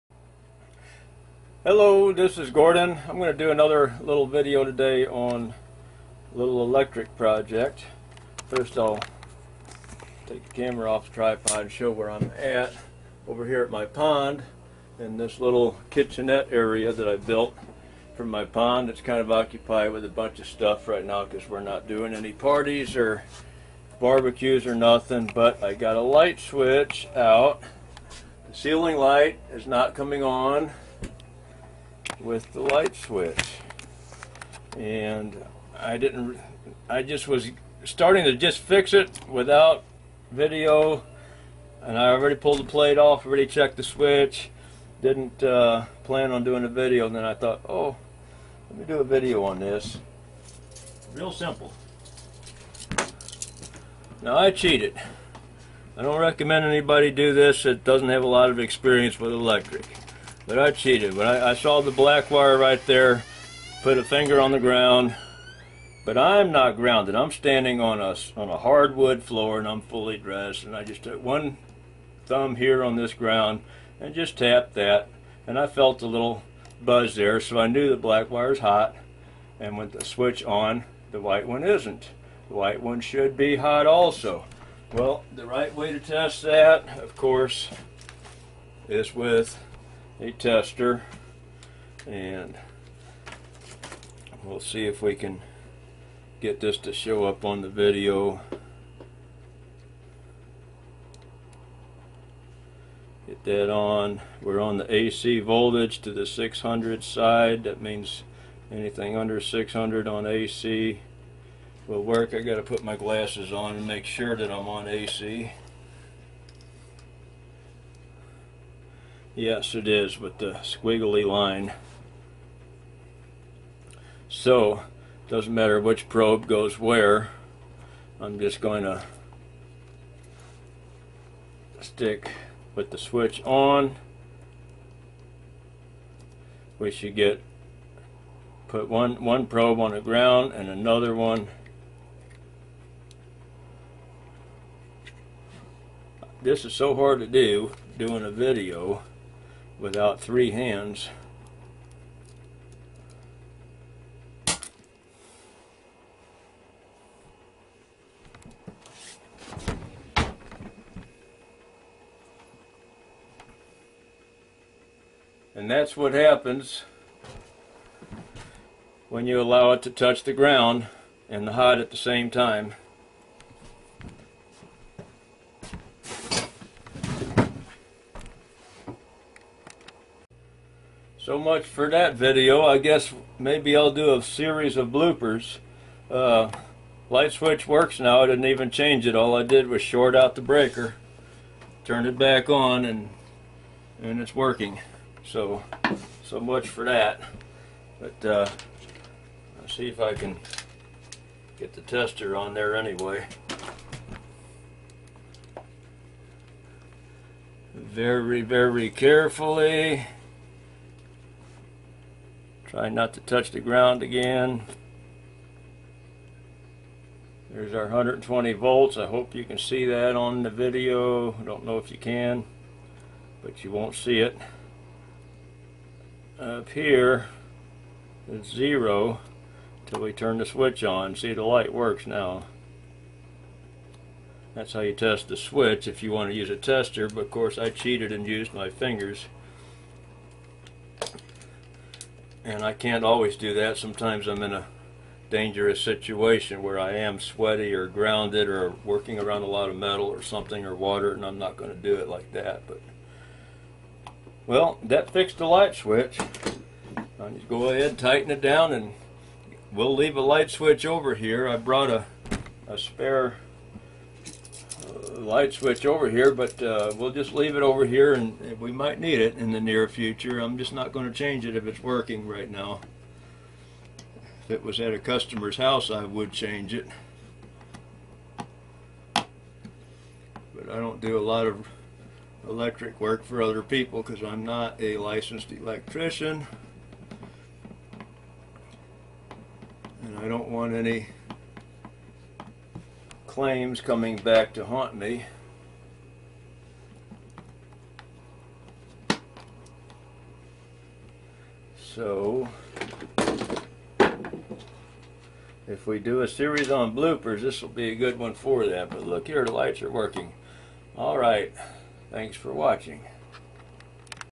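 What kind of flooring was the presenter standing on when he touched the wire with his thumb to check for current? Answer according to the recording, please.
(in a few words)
hardwood floor.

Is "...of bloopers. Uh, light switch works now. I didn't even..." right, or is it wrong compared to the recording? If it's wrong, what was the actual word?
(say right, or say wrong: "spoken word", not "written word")
right.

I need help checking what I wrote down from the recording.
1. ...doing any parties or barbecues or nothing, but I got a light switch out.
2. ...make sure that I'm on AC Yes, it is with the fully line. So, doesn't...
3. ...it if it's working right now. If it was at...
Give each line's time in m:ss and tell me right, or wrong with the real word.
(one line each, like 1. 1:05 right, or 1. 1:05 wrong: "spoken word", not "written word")
1. 0:21 right
2. 1:53 wrong: "squiggly", not "fully"
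3. 4:31 right.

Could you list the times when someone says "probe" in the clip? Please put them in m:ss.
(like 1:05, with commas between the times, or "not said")
2:06, 2:19.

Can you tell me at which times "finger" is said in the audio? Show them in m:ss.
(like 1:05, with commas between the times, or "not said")
1:04, 3:58.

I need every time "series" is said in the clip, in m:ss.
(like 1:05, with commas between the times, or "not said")
3:04, 5:06.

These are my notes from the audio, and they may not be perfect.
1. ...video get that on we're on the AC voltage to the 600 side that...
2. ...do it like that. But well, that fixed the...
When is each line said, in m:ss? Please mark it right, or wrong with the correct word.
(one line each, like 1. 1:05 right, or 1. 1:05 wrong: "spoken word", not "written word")
1. 1:37 right
2. 4:11 right.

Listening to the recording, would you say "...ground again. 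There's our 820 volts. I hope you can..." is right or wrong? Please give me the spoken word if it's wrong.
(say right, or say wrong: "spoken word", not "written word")
wrong: "120", not "820".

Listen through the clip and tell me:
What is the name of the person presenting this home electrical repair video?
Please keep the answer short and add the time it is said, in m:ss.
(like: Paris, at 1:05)
Gordon, at 0:02.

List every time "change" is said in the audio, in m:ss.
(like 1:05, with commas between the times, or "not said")
3:08, 4:31, 4:36.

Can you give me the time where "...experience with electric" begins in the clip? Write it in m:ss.
0:58.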